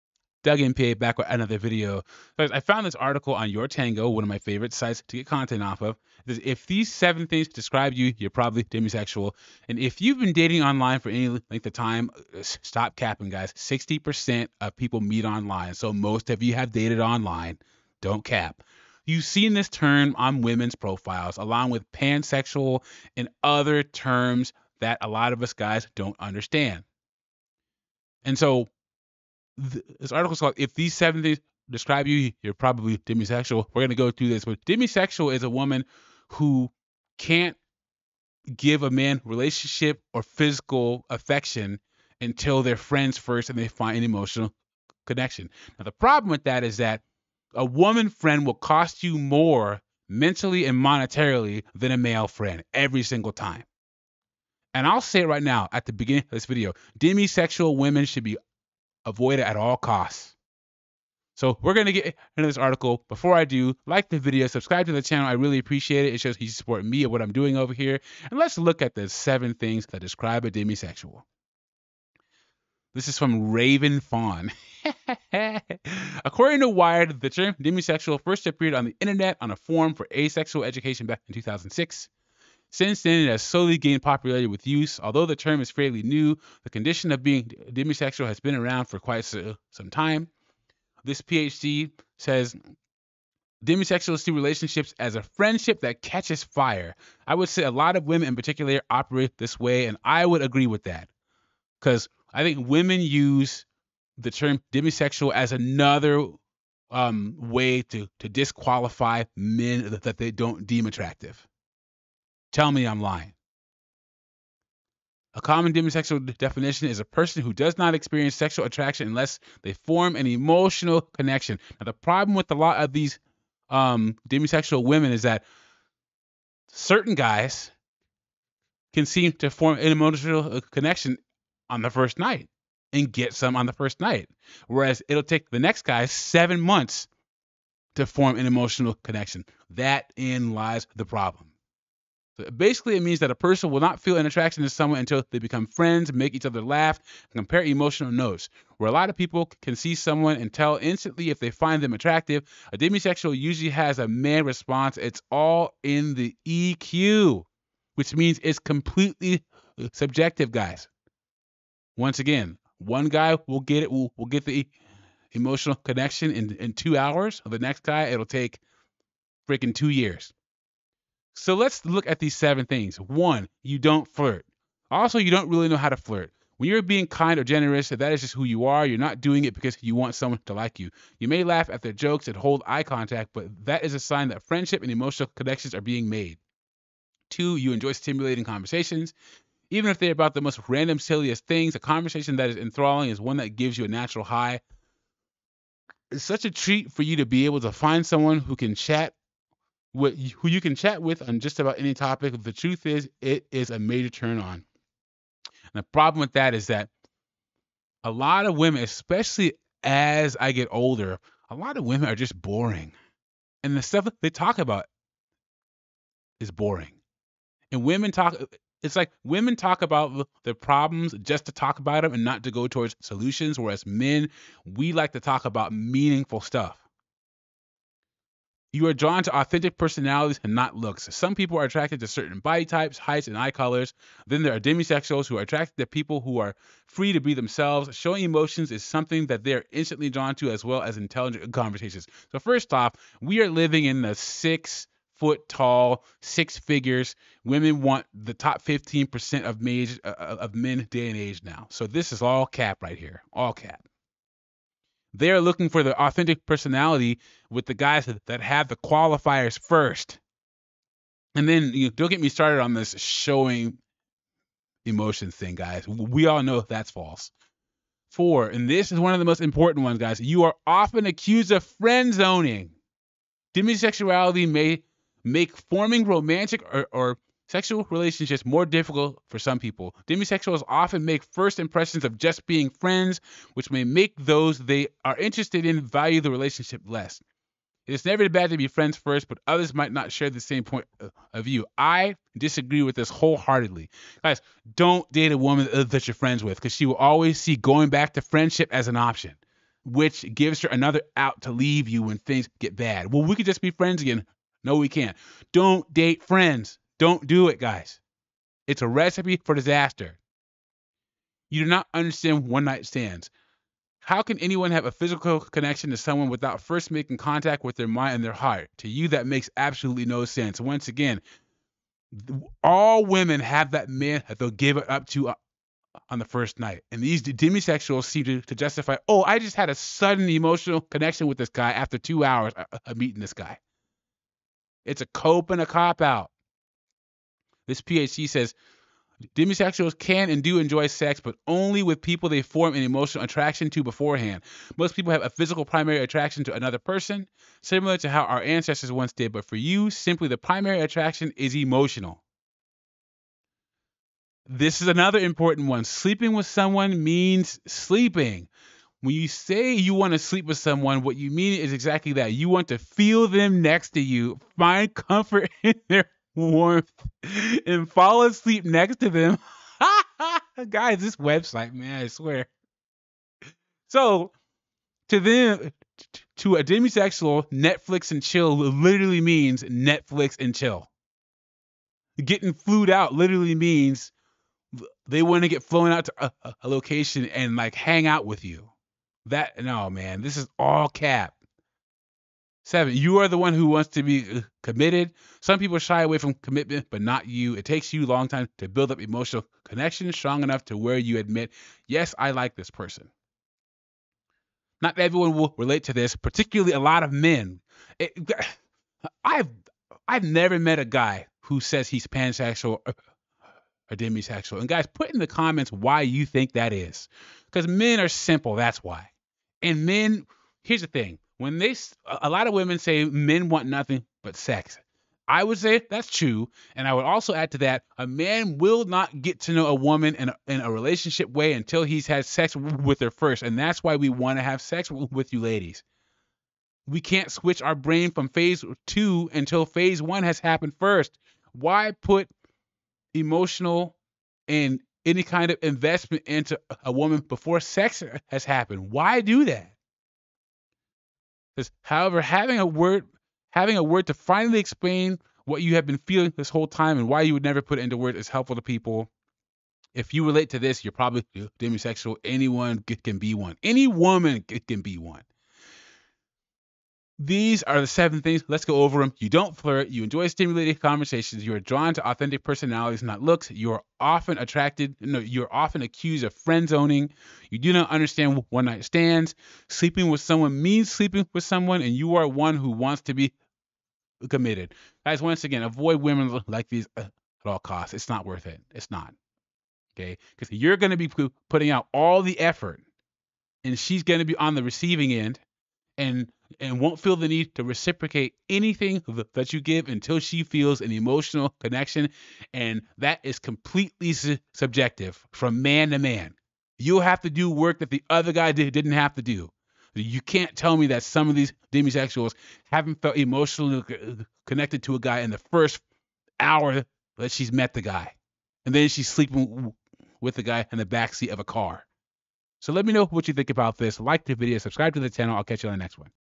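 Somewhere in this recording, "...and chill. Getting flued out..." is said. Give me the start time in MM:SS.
06:20.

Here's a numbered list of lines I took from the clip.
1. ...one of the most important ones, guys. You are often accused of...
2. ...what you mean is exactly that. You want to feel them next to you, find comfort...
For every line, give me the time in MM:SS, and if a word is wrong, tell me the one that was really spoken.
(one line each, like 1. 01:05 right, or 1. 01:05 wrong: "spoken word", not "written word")
1. 04:28 right
2. 06:01 right.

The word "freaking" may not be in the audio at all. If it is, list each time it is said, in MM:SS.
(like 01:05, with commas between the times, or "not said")
02:49.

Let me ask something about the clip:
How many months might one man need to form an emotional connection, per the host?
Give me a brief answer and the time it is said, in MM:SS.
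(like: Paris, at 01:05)
7, at 02:16.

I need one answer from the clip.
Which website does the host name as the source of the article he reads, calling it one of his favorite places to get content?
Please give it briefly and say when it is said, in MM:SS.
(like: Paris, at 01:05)
Your Tango, at 00:03.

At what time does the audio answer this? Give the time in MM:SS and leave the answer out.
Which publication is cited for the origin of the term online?
01:16.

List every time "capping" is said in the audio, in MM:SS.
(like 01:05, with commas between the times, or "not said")
00:12.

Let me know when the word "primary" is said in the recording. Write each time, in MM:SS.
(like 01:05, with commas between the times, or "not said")
05:45, 05:50.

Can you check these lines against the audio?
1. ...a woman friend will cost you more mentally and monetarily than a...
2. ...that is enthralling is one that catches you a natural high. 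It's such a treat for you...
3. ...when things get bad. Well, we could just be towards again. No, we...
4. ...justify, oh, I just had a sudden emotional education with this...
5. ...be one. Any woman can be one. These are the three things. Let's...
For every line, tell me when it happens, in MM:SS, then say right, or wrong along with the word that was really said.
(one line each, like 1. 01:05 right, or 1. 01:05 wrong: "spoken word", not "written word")
1. 00:47 right
2. 03:12 wrong: "gives", not "catches"
3. 05:02 wrong: "friends", not "towards"
4. 05:28 wrong: "connection", not "education"
5. 07:43 wrong: "seven", not "three".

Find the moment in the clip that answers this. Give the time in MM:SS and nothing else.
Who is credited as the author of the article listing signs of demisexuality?
01:13.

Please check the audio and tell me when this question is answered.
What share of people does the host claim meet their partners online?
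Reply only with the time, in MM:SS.
00:13.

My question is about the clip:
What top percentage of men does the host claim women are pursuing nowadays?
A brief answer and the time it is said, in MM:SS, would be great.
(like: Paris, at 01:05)
15%, at 04:08.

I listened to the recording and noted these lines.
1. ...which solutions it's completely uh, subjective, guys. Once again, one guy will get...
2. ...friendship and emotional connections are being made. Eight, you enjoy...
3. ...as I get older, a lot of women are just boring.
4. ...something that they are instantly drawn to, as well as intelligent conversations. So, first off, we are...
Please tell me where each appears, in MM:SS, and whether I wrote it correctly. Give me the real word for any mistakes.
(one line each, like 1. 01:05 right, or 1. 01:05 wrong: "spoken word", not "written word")
1. 02:37 wrong: "means", not "solutions"
2. 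03:04 wrong: "Two", not "Eight"
3. 03:29 right
4. 03:58 right.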